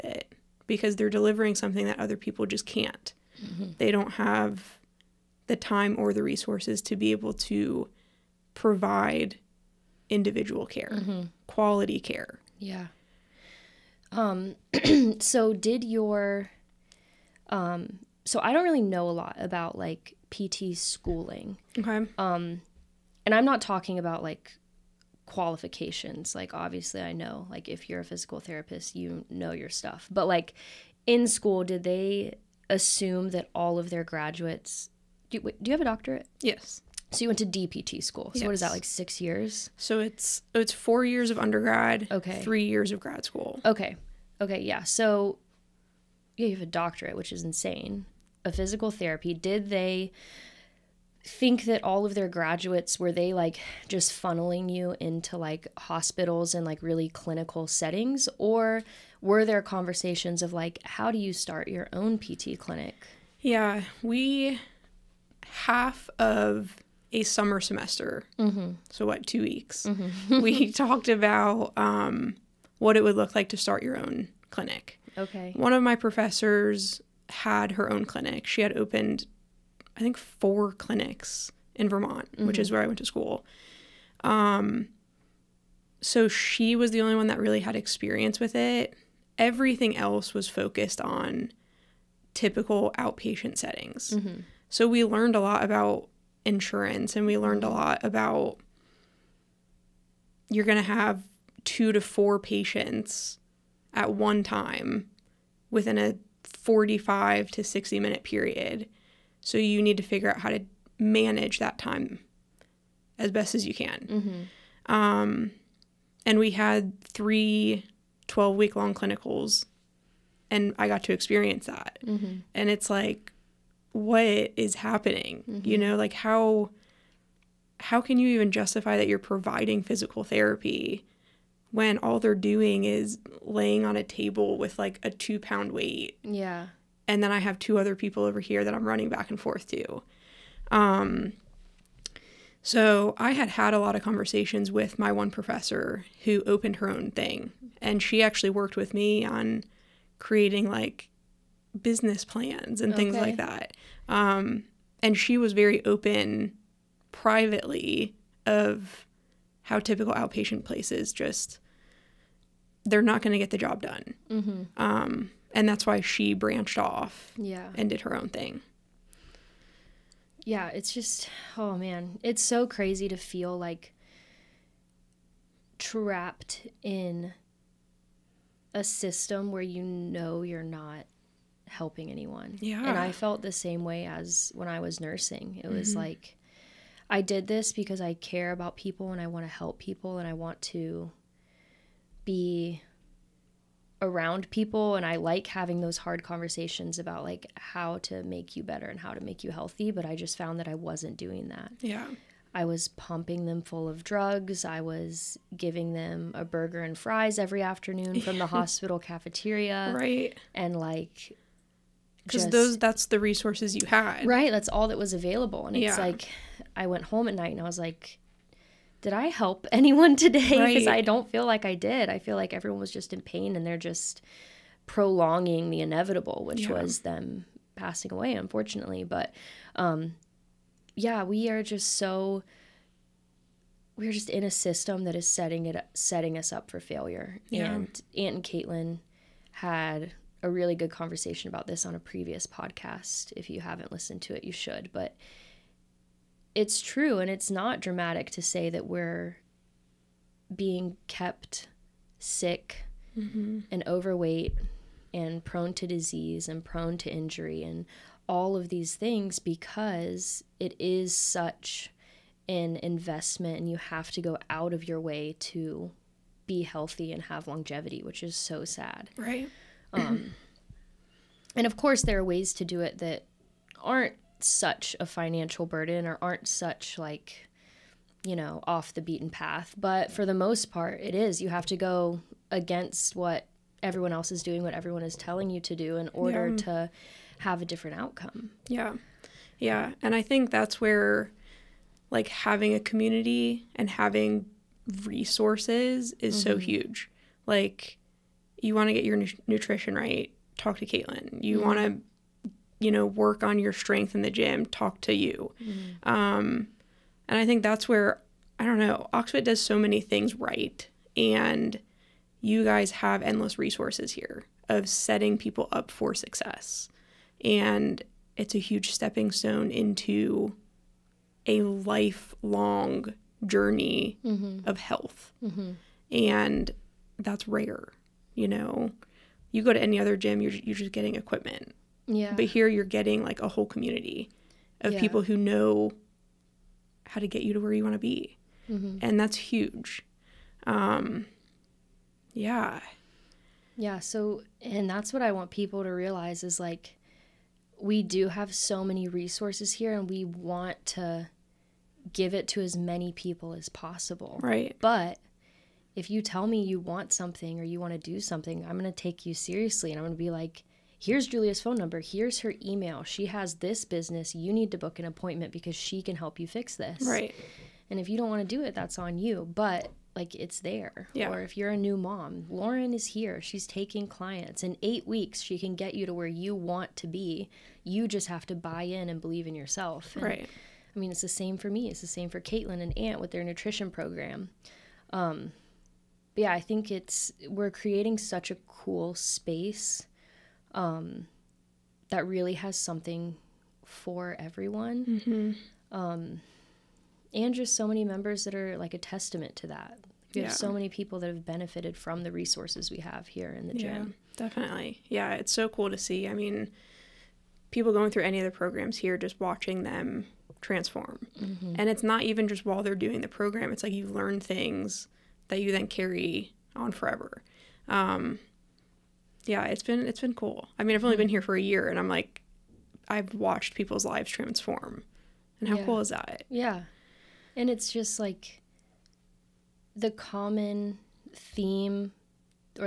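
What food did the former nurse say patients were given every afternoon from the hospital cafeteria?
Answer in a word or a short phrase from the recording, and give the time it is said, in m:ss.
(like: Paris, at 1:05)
A burger and fries, at 3:26.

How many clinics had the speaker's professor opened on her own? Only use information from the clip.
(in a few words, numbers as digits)
4.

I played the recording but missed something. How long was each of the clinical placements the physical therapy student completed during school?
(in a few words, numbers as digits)
12 weeks.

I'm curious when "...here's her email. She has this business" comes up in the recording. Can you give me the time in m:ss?
6:02.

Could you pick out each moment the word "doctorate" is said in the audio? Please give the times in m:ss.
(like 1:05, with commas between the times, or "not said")
0:35, 0:46.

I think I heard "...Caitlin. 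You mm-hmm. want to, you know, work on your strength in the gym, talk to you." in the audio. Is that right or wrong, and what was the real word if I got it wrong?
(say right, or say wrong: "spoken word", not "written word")
right.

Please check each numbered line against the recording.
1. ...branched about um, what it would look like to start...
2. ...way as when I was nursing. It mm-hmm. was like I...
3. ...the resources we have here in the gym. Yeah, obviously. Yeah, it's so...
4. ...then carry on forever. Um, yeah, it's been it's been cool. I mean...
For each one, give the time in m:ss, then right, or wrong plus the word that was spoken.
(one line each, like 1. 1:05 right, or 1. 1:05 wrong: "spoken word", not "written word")
1. 1:10 wrong: "talked", not "branched"
2. 3:03 right
3. 6:42 wrong: "definitely", not "obviously"
4. 6:55 right.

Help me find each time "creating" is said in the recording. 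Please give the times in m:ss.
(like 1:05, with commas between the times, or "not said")
2:30, 6:27.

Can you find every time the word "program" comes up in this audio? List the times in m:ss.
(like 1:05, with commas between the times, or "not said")
6:23, 6:48, 6:53.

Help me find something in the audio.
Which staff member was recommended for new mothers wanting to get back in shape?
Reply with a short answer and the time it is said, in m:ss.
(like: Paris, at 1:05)
Lauren, at 6:12.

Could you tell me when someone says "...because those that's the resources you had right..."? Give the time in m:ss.
3:32.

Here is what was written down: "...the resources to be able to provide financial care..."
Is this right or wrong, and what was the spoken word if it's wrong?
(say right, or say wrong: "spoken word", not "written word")
wrong: "individual", not "financial".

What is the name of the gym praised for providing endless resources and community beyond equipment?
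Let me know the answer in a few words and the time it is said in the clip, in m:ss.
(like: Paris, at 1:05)
Oxfit, at 5:09.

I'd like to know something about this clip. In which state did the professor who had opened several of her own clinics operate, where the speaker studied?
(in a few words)
Vermont.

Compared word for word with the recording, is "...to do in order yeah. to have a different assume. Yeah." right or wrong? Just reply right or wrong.
wrong.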